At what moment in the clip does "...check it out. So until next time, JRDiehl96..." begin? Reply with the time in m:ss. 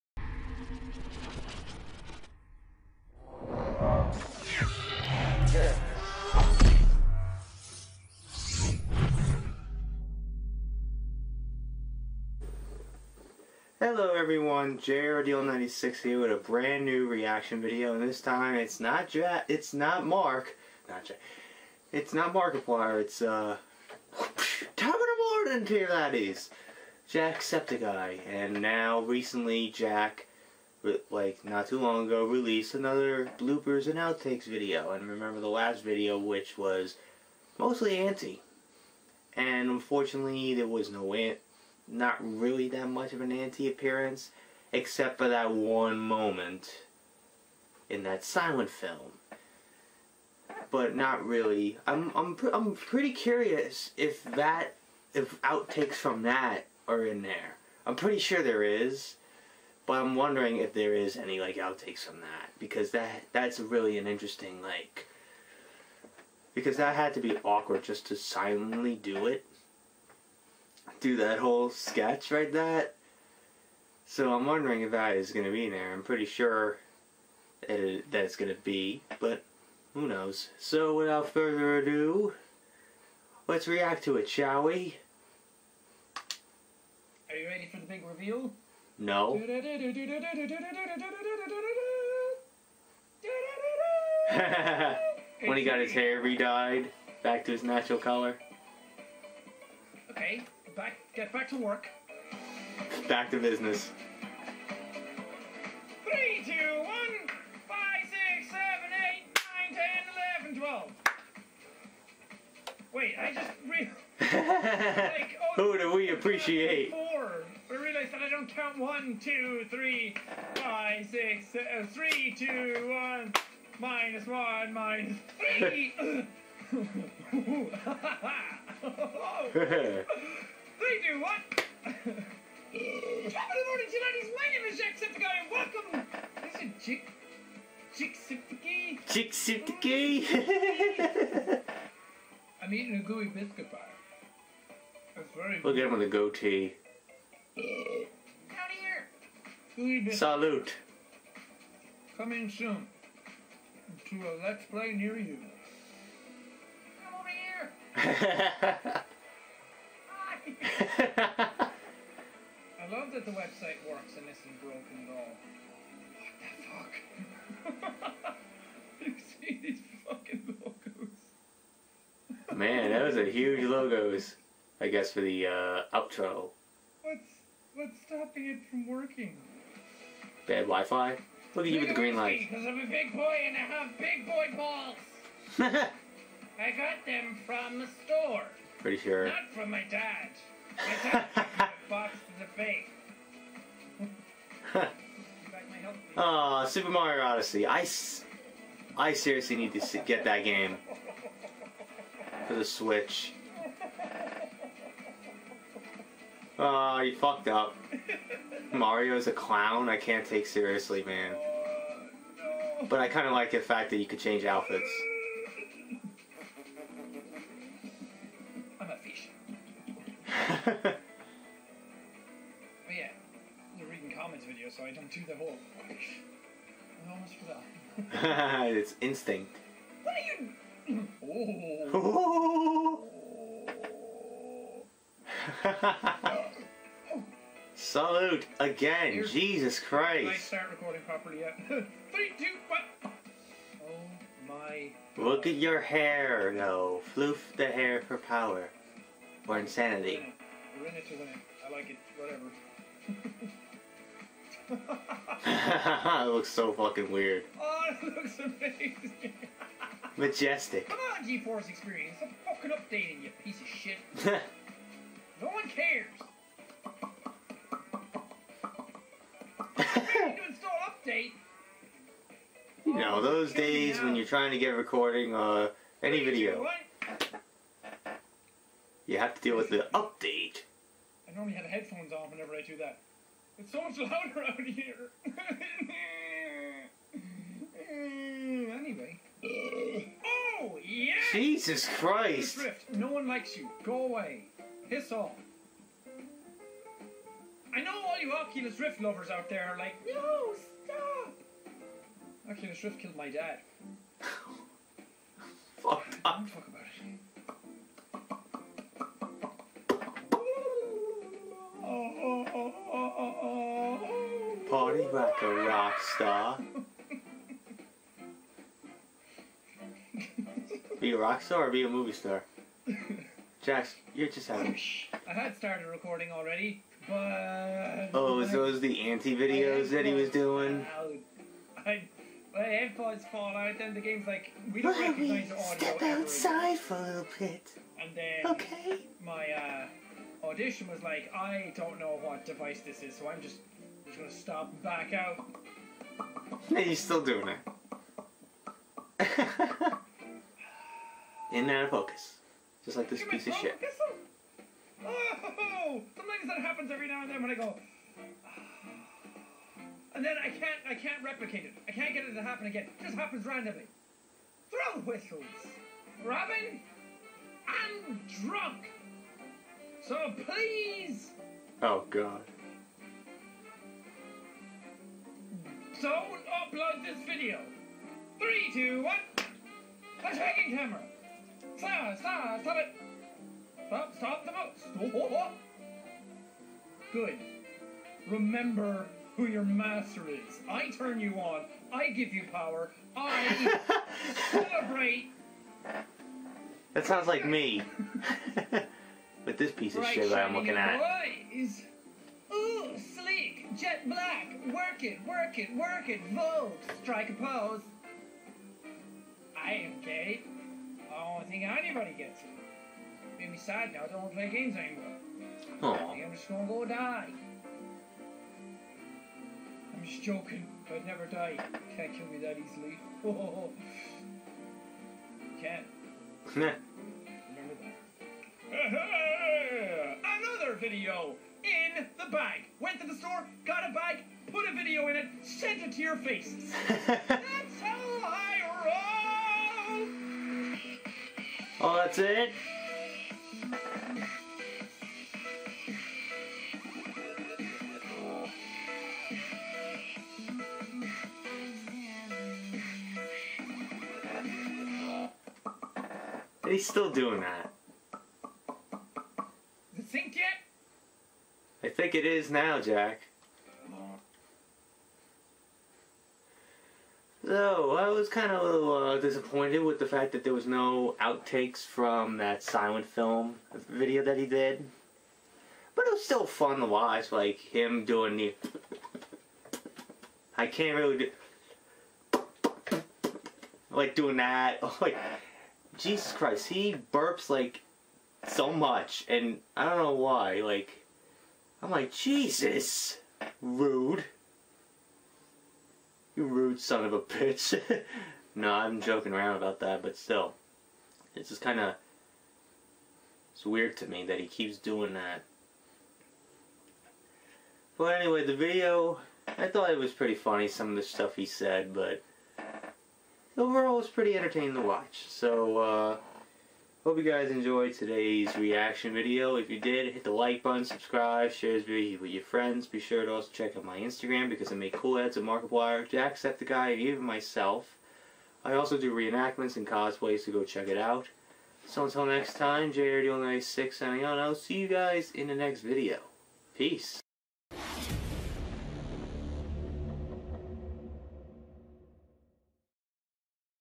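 8:50.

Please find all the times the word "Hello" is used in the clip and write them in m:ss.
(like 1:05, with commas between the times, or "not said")
0:13.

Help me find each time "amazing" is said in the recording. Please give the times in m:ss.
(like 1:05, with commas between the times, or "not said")
4:18.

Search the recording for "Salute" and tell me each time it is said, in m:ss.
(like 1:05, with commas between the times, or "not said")
2:30, 3:57.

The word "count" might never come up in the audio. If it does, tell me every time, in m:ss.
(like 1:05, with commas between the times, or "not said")
1:58.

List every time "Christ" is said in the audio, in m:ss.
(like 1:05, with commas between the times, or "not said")
3:59, 4:51, 8:06.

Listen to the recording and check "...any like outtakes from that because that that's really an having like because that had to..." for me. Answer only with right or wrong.
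wrong.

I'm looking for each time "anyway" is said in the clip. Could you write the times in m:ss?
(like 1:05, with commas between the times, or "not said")
4:48, 8:28.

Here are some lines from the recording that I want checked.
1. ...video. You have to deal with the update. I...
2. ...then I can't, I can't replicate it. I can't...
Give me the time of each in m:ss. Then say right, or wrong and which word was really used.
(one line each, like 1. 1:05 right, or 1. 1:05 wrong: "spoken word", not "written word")
1. 4:36 right
2. 6:00 right.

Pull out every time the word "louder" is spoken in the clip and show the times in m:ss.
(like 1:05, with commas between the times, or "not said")
4:43.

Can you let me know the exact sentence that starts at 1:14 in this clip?
So I'm wondering if that is going to be in there.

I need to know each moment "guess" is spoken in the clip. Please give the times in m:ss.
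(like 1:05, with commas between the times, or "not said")
2:54.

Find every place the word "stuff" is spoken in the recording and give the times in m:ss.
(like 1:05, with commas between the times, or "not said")
8:31.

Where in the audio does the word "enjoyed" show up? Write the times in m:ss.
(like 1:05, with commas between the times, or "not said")
8:37.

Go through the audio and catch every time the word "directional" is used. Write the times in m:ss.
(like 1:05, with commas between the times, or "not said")
not said.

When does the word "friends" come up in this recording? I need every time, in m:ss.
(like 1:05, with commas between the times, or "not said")
8:42.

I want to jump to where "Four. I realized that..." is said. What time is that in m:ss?
1:56.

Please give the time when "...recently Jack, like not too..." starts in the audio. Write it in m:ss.
0:28.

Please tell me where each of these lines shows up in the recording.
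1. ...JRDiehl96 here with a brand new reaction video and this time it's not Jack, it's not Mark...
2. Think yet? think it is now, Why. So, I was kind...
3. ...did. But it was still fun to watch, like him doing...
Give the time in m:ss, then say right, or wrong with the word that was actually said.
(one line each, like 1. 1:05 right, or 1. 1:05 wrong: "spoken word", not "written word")
1. 0:14 right
2. 7:40 wrong: "Jack", not "Why"
3. 7:54 right.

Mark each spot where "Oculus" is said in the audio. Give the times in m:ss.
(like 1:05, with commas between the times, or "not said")
4:58, 5:02.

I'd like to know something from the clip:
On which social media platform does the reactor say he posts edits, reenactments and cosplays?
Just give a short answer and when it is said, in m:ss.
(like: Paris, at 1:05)
Instagram, at 8:43.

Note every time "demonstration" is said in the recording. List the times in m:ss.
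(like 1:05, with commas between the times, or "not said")
not said.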